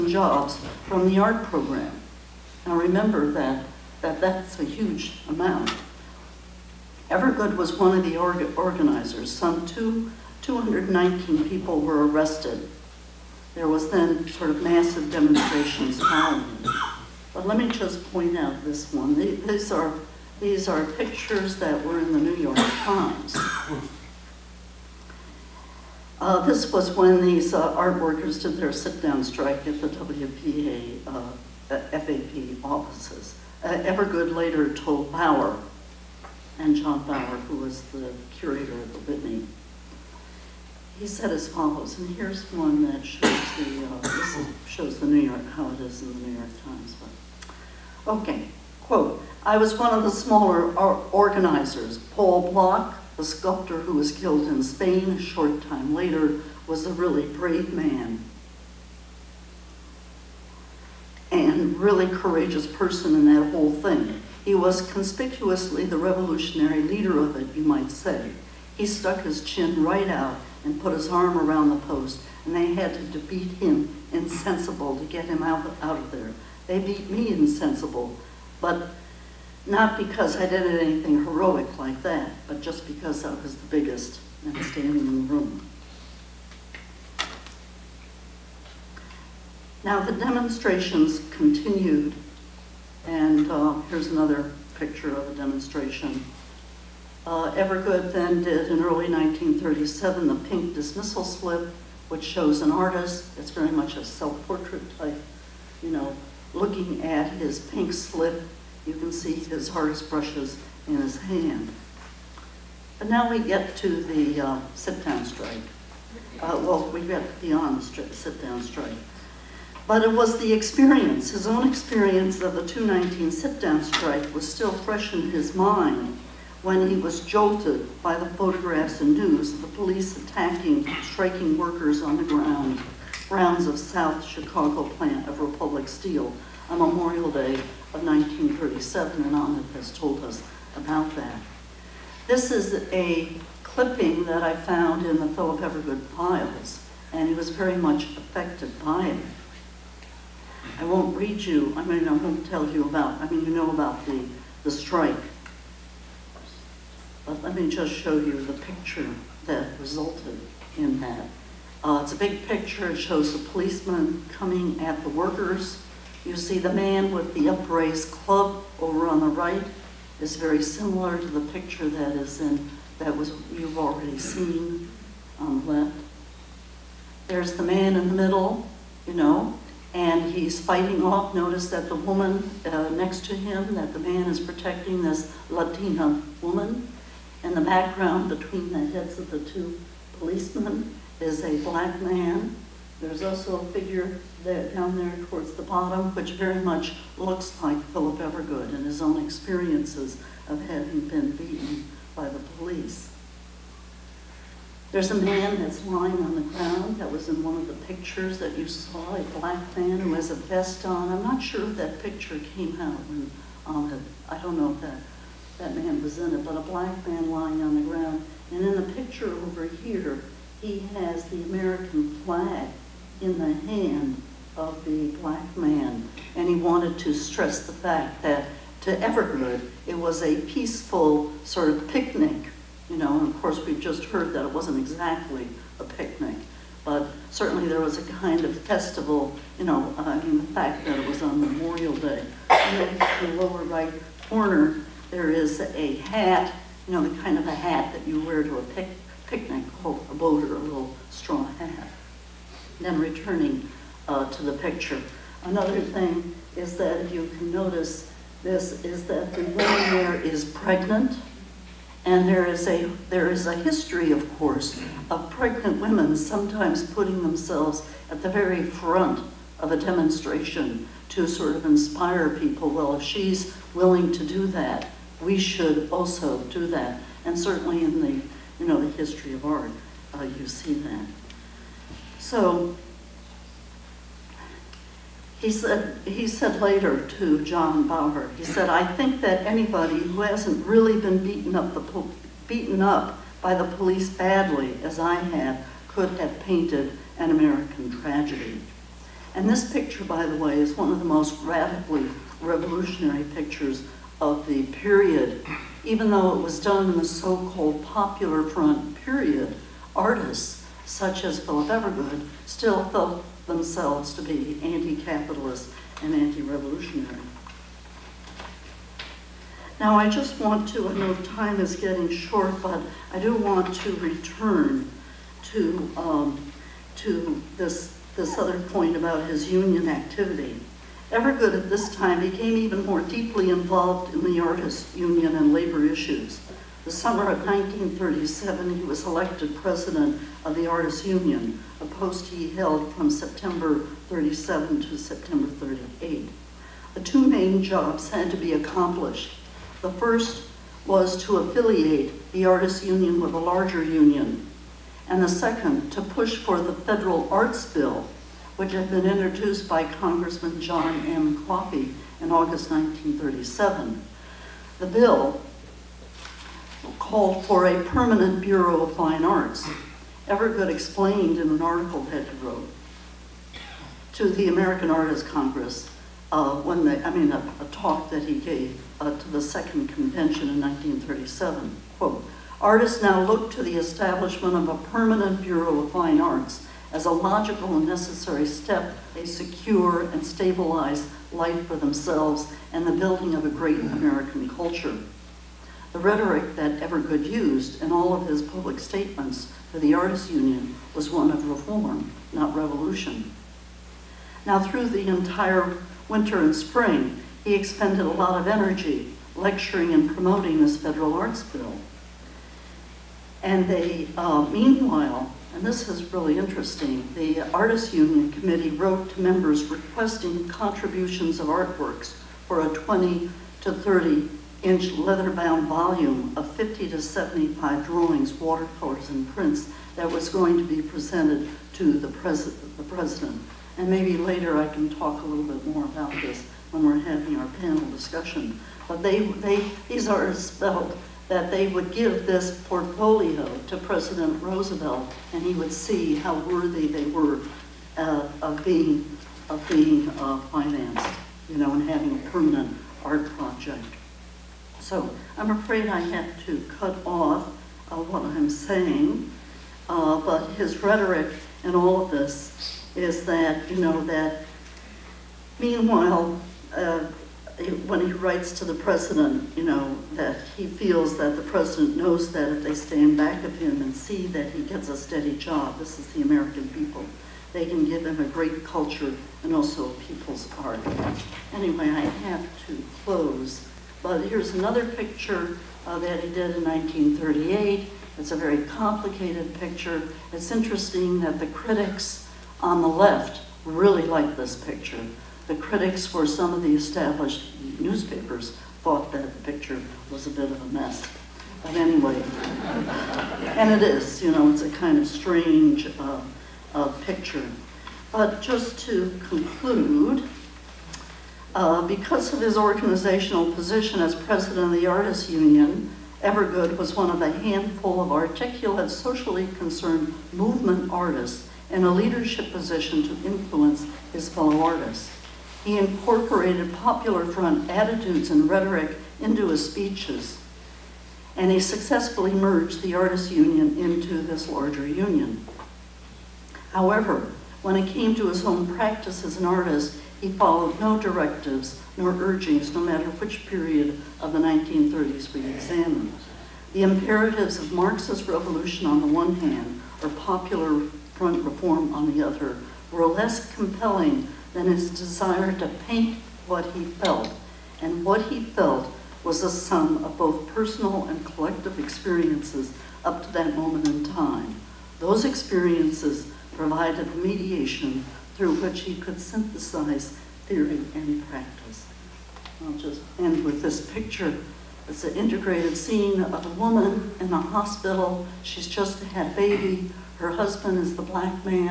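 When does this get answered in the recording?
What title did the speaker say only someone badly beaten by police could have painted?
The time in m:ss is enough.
4:57.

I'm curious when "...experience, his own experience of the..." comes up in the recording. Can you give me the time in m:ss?
2:00.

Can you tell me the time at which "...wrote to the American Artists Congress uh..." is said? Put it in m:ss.
6:12.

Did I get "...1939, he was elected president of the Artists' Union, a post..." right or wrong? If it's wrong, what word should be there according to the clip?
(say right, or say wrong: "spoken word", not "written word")
wrong: "1937", not "1939".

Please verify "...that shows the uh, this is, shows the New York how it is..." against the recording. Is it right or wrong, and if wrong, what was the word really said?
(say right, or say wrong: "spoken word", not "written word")
right.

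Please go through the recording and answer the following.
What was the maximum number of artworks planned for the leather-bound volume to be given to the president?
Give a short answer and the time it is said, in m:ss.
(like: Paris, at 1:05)
75, at 7:06.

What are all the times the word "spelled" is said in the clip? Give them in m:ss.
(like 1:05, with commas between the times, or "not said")
7:20.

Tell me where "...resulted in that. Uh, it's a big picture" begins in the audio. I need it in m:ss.
2:39.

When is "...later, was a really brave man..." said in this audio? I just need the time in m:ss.
0:55.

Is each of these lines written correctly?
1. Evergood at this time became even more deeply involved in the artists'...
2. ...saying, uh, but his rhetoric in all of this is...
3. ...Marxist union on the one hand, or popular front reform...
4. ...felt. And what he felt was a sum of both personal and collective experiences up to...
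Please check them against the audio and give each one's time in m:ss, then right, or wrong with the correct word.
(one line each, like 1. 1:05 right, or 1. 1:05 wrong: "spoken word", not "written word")
1. 5:31 right
2. 7:38 right
3. 9:07 wrong: "revolution", not "union"
4. 9:16 right.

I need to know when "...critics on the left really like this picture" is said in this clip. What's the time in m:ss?
8:11.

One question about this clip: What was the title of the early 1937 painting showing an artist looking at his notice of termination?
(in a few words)
The Pink Dismissal Slip.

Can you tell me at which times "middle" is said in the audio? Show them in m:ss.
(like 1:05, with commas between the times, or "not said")
2:58.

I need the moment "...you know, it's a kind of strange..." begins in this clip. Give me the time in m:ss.
8:24.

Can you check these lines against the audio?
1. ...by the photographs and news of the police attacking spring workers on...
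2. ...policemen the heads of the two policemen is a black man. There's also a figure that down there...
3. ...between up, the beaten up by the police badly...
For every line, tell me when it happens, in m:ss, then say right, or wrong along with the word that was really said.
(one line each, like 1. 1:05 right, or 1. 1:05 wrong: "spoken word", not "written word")
1. 2:08 wrong: "striking", not "spring"
2. 3:08 wrong: "between", not "policemen"
3. 4:51 wrong: "beaten", not "between".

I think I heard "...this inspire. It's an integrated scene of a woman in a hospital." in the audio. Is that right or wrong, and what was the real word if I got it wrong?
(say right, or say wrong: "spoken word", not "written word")
wrong: "picture", not "inspire".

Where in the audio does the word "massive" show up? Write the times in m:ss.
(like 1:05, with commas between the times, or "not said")
0:14.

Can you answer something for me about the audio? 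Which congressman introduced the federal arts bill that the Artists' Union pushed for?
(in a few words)
John M. Coffee.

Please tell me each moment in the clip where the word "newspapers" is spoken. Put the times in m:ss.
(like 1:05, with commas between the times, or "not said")
8:17.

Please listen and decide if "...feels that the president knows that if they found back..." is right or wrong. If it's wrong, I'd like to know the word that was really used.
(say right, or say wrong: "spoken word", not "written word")
wrong: "stand", not "found".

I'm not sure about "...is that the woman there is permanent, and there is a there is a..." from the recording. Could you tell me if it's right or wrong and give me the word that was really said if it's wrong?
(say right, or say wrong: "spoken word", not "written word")
wrong: "pregnant", not "permanent".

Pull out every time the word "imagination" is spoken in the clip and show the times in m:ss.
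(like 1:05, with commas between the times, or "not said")
not said.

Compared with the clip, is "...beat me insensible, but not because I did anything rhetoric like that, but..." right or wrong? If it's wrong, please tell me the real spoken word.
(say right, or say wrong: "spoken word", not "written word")
wrong: "heroic", not "rhetoric".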